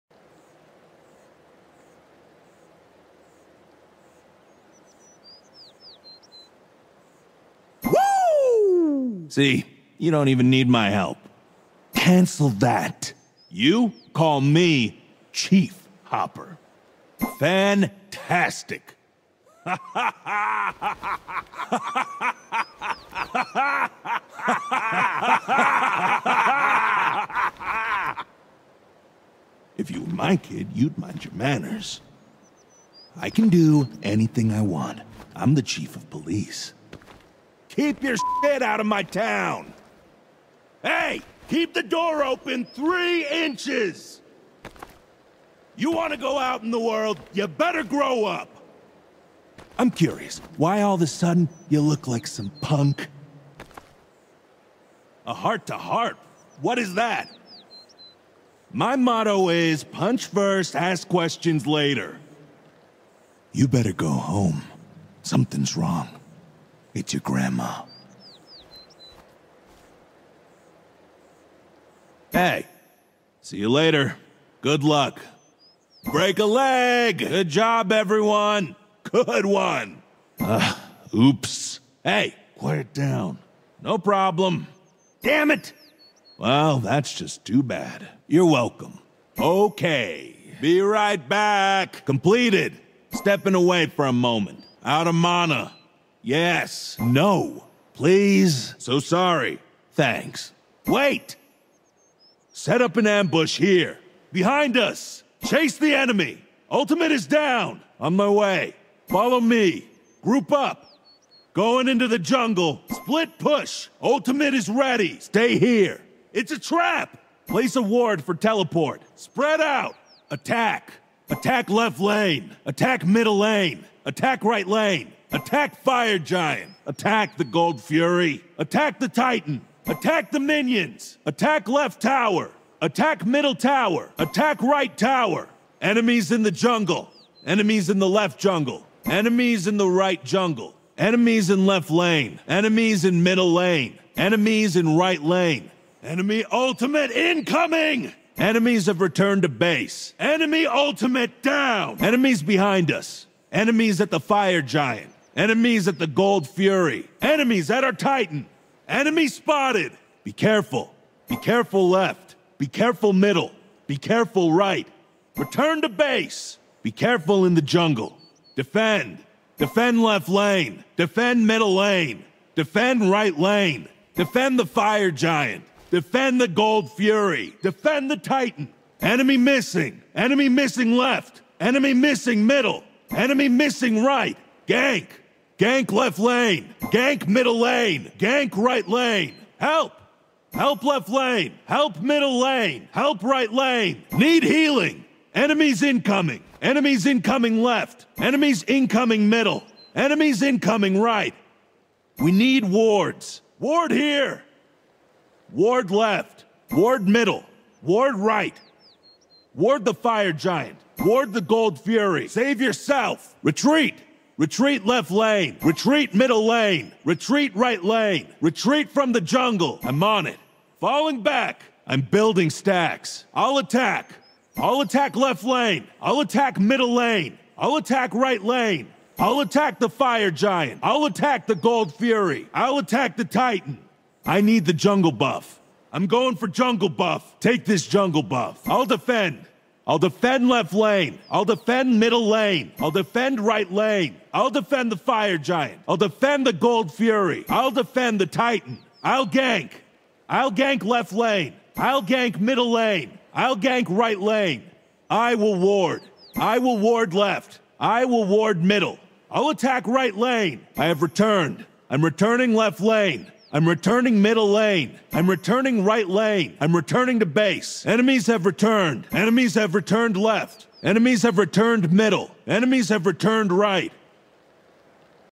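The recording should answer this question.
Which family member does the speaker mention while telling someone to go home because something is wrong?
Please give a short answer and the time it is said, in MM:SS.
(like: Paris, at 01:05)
Grandma, at 01:07.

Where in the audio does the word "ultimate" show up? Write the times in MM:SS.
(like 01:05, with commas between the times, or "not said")
01:46, 01:54, 02:26, 02:30.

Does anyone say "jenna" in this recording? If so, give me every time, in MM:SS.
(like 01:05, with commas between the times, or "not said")
not said.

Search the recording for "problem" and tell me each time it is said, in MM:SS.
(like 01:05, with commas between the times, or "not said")
01:23.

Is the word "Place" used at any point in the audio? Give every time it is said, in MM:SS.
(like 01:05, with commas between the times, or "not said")
01:57.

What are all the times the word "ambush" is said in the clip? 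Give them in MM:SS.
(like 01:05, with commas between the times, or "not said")
01:43.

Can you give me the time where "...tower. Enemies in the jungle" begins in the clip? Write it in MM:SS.
02:14.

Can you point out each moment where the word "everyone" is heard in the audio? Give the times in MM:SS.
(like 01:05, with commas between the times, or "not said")
01:17.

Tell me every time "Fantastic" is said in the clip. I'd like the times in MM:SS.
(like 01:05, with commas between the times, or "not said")
00:17.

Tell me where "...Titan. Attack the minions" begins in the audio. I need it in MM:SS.
02:09.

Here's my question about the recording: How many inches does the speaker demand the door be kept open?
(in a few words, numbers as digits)
3.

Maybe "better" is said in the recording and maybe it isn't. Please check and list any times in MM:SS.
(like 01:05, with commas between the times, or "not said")
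00:47, 01:03.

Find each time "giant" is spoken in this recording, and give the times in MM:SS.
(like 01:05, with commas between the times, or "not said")
02:06, 02:34, 02:55, 03:30, 03:50, 04:05.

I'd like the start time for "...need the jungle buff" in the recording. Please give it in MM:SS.
03:54.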